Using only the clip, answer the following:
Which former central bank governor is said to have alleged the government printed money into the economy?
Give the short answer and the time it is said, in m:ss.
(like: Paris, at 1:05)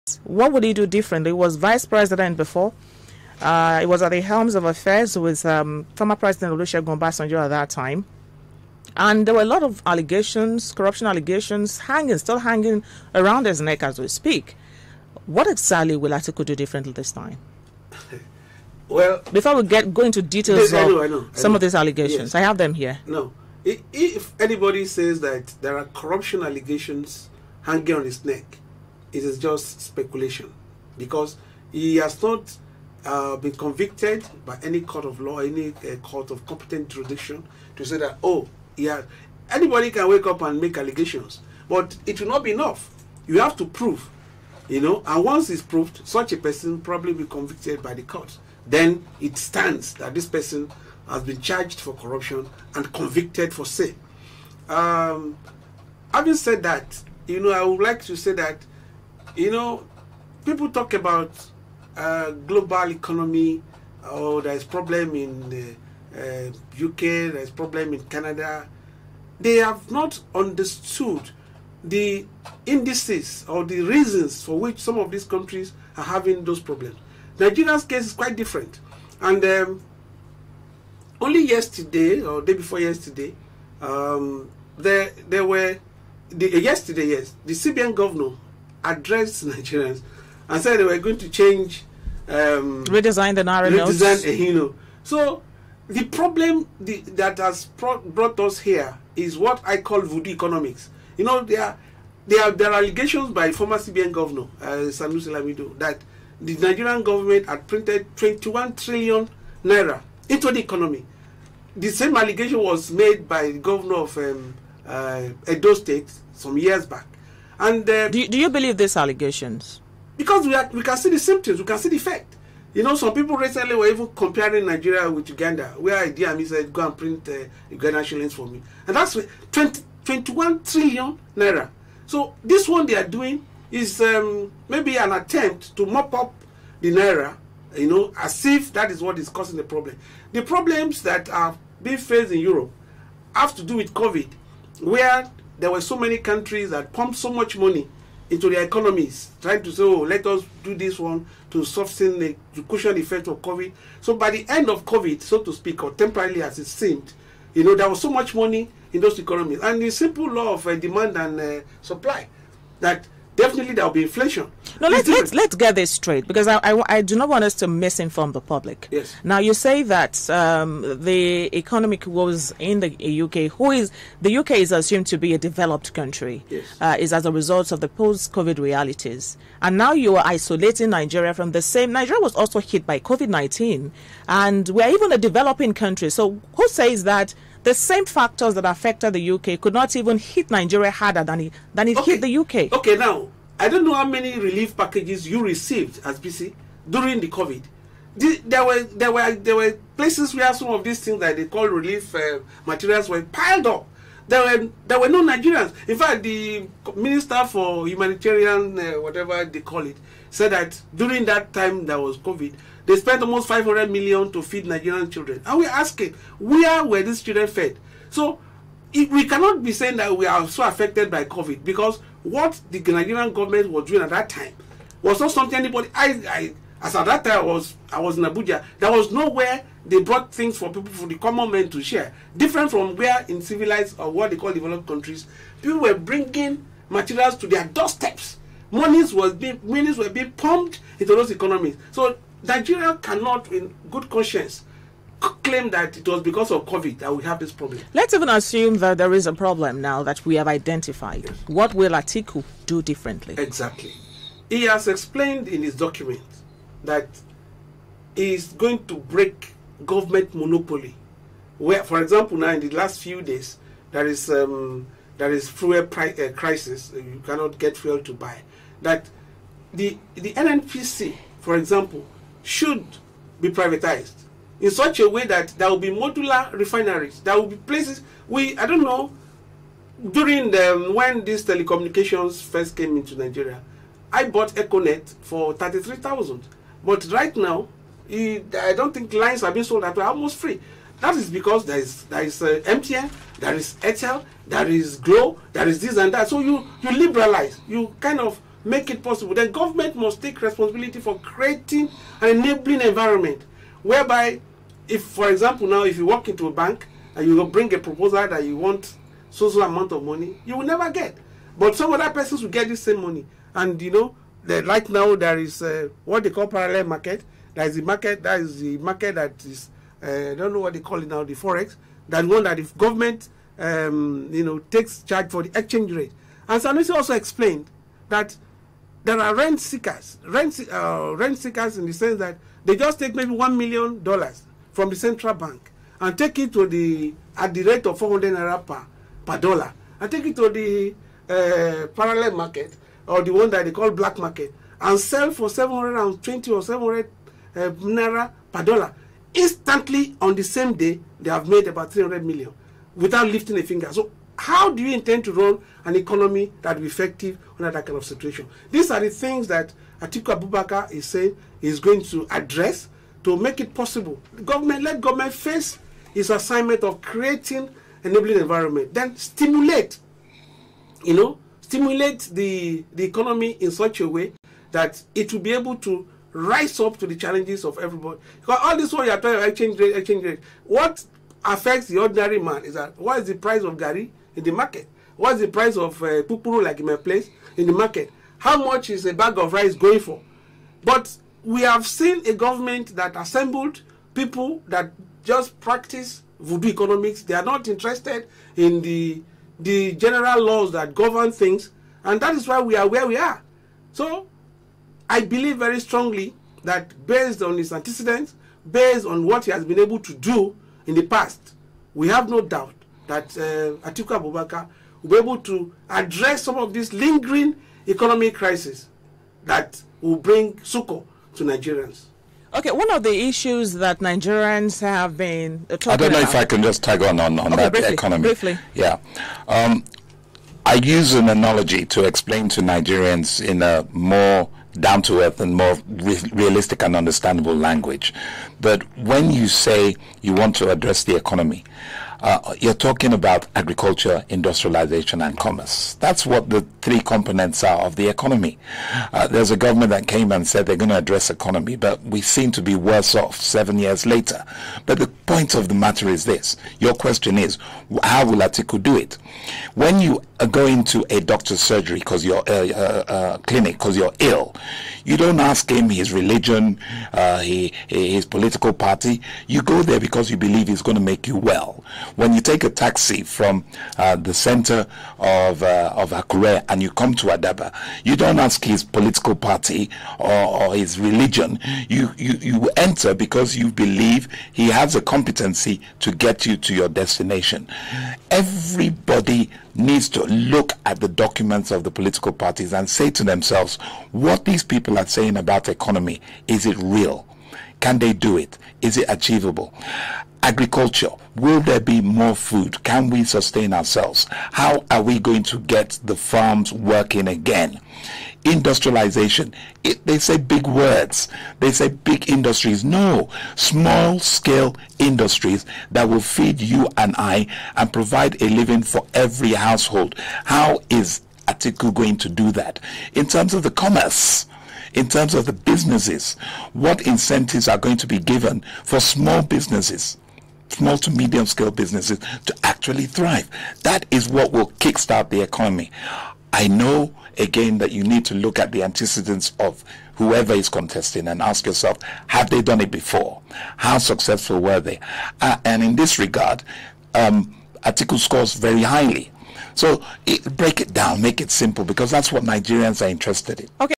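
Sanusi Lamido, at 1:44.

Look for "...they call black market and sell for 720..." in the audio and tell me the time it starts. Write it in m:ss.
5:43.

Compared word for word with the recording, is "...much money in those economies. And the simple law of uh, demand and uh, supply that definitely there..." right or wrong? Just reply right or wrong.
right.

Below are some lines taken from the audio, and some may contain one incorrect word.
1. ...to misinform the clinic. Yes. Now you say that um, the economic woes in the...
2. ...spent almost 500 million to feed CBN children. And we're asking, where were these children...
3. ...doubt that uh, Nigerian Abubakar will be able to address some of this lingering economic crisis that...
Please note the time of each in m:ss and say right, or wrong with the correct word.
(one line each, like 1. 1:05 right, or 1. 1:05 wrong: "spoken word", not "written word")
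1. 2:47 wrong: "public", not "clinic"
2. 3:32 wrong: "Nigerian", not "CBN"
3. 6:52 wrong: "Atiku", not "Nigerian".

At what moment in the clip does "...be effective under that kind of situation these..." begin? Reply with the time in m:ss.
5:56.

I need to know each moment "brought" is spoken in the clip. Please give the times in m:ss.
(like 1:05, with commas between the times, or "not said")
1:37, 3:50.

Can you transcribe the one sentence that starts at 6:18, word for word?
Because all this what you are talking about exchange rate, exchange rate.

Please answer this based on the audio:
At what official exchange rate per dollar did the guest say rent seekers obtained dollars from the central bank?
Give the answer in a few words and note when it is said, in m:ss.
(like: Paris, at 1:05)
400 naira, at 5:37.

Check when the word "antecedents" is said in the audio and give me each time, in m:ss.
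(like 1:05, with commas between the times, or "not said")
6:47, 8:58.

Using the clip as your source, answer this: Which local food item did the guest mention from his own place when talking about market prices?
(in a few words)
pupuru.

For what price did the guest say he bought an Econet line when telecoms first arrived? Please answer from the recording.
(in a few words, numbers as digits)
33,000.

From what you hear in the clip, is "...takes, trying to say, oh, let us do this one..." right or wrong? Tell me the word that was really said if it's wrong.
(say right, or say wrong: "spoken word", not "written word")
wrong: "economies", not "takes".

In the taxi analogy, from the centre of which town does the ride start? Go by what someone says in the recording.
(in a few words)
Akure.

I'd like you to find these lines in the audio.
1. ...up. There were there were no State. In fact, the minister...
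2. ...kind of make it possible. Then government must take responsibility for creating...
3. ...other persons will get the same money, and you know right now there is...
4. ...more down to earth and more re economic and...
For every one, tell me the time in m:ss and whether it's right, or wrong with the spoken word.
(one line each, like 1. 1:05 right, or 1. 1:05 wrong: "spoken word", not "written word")
1. 3:23 wrong: "Nigerians", not "State"
2. 4:57 right
3. 5:11 right
4. 7:13 wrong: "realistic", not "economic".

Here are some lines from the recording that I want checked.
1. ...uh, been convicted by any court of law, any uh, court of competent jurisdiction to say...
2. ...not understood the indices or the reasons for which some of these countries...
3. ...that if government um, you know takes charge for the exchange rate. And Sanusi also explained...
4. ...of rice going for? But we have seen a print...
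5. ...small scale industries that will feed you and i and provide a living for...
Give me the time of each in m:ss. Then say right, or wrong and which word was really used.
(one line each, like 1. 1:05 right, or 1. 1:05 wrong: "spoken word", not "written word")
1. 0:33 right
2. 1:09 right
3. 5:22 right
4. 6:29 wrong: "government", not "print"
5. 8:33 right.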